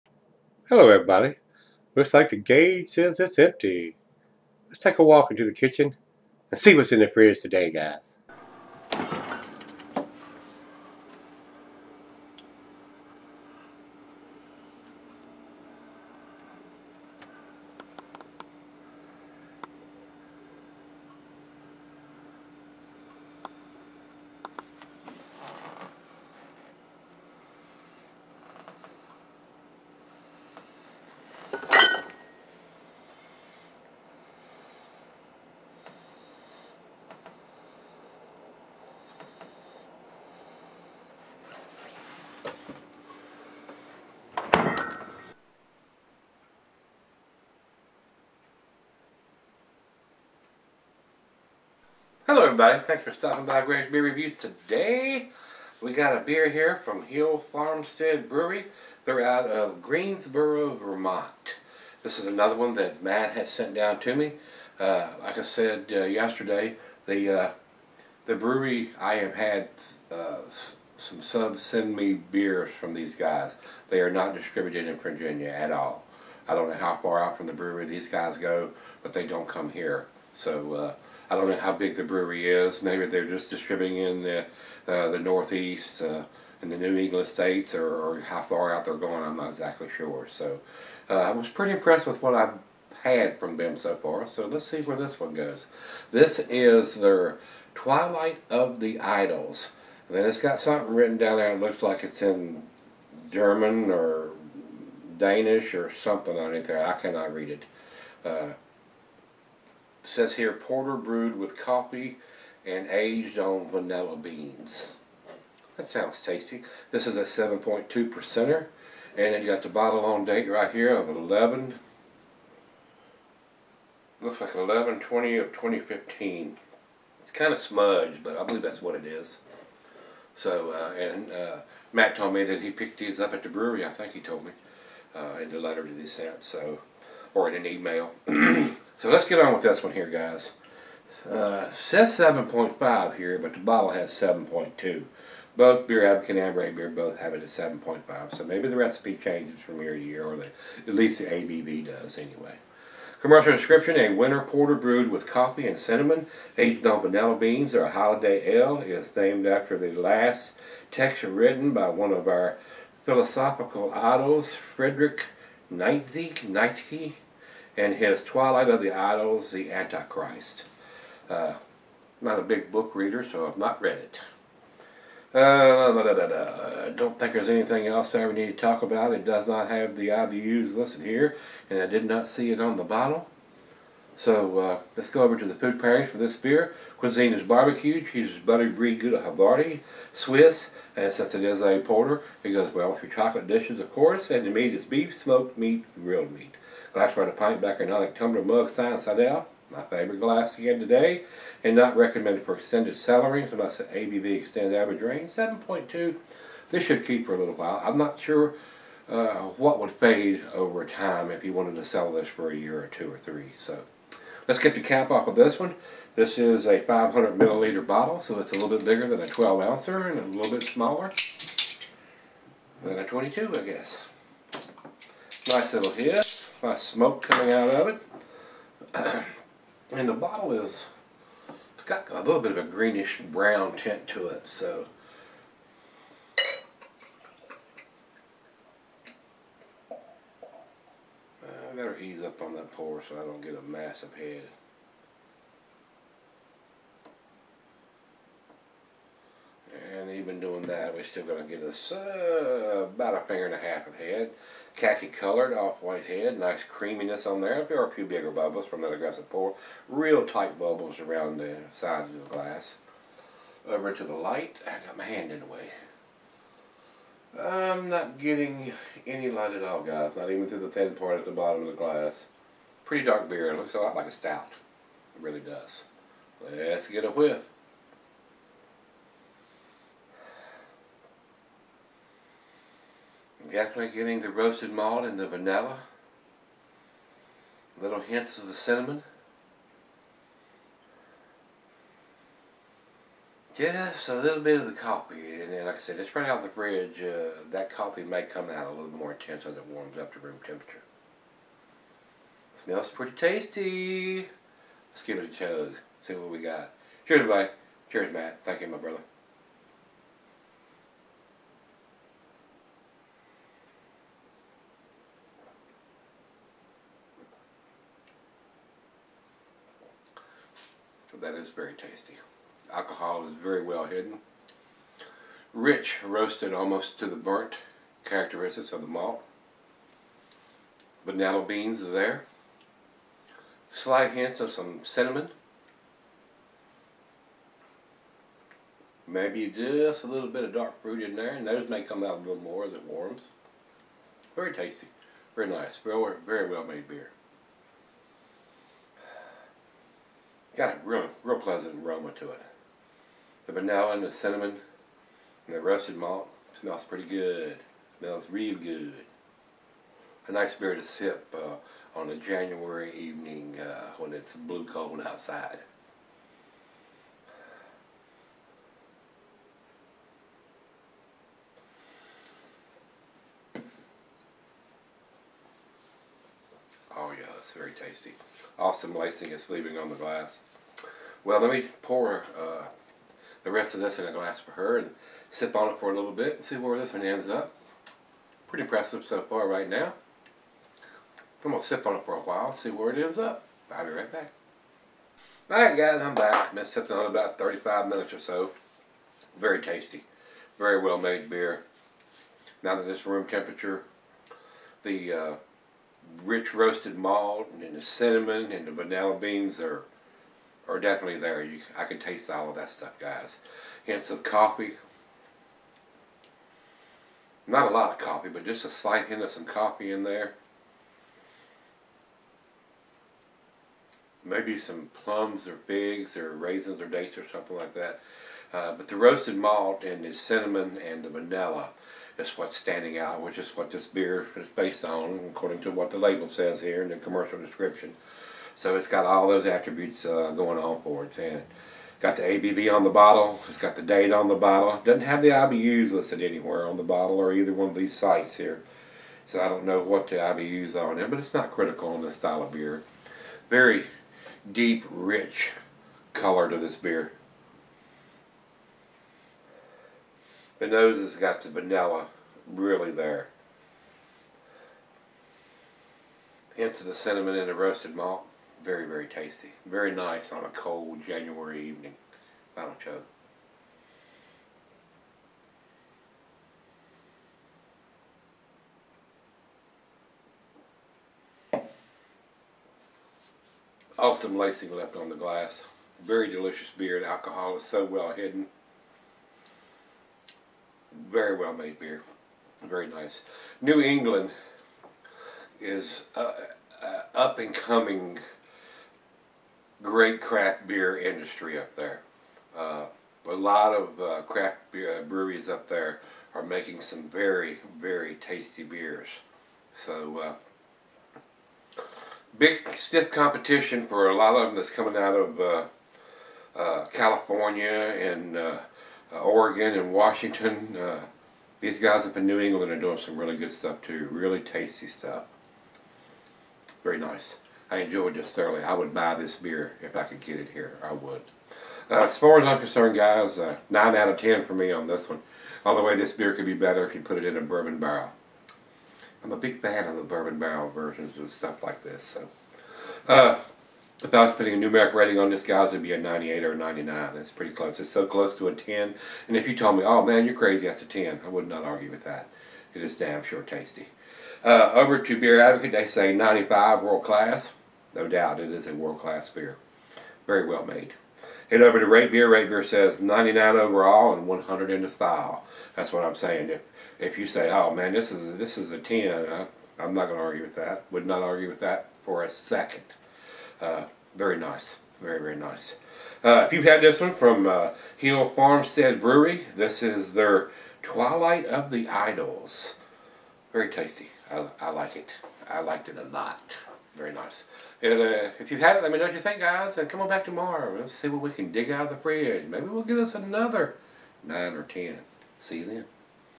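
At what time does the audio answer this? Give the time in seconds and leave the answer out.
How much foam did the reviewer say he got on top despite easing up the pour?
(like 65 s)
253 s.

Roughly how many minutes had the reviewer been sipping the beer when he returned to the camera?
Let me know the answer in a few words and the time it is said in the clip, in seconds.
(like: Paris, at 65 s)
35, at 397 s.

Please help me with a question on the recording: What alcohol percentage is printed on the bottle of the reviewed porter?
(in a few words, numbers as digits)
7.2 percent.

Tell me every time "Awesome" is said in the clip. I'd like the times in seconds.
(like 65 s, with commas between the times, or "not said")
378 s, 483 s.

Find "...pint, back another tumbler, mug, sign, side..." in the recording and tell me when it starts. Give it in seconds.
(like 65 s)
197 s.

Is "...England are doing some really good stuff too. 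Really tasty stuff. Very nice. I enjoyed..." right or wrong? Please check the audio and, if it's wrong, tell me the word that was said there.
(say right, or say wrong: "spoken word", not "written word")
right.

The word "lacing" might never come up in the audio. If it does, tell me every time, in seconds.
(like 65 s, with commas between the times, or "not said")
378 s, 484 s.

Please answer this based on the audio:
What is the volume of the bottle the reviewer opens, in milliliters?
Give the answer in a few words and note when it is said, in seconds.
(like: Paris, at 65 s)
500, at 216 s.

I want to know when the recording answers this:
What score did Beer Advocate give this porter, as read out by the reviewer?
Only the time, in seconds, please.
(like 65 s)
556 s.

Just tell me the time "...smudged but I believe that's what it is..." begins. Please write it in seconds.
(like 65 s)
127 s.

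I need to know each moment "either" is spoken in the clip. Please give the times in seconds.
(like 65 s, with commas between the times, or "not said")
447 s.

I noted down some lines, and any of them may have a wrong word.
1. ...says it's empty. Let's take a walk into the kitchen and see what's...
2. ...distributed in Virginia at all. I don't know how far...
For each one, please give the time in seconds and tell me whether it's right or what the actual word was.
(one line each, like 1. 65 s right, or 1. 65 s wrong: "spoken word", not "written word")
1. 2 s right
2. 74 s right.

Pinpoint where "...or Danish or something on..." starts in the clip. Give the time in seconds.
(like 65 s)
103 s.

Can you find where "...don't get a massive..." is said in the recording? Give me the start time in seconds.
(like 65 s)
243 s.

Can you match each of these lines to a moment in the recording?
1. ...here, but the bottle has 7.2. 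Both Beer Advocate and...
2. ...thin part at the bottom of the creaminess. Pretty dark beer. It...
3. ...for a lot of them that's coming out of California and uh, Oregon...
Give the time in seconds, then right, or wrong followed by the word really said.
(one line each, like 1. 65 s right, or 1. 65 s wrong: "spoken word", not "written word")
1. 143 s right
2. 270 s wrong: "glass", not "creaminess"
3. 513 s right.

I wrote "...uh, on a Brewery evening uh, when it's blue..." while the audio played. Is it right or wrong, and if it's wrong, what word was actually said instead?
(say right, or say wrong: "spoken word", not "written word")
wrong: "January", not "Brewery".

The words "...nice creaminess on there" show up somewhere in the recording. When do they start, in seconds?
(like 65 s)
256 s.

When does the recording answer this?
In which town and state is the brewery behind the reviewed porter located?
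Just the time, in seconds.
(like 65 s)
59 s.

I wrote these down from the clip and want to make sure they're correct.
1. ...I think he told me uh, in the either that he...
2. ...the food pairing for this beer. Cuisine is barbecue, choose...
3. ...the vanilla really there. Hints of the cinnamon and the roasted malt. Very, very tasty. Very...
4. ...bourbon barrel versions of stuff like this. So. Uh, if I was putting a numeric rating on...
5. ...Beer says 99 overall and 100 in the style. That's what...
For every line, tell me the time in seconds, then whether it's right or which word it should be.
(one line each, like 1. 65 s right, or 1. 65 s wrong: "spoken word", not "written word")
1. 133 s wrong: "letter", not "either"
2. 185 s right
3. 461 s right
4. 540 s right
5. 562 s right.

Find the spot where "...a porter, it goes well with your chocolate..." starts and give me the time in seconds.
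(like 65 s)
191 s.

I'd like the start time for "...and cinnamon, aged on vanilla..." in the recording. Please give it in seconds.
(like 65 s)
155 s.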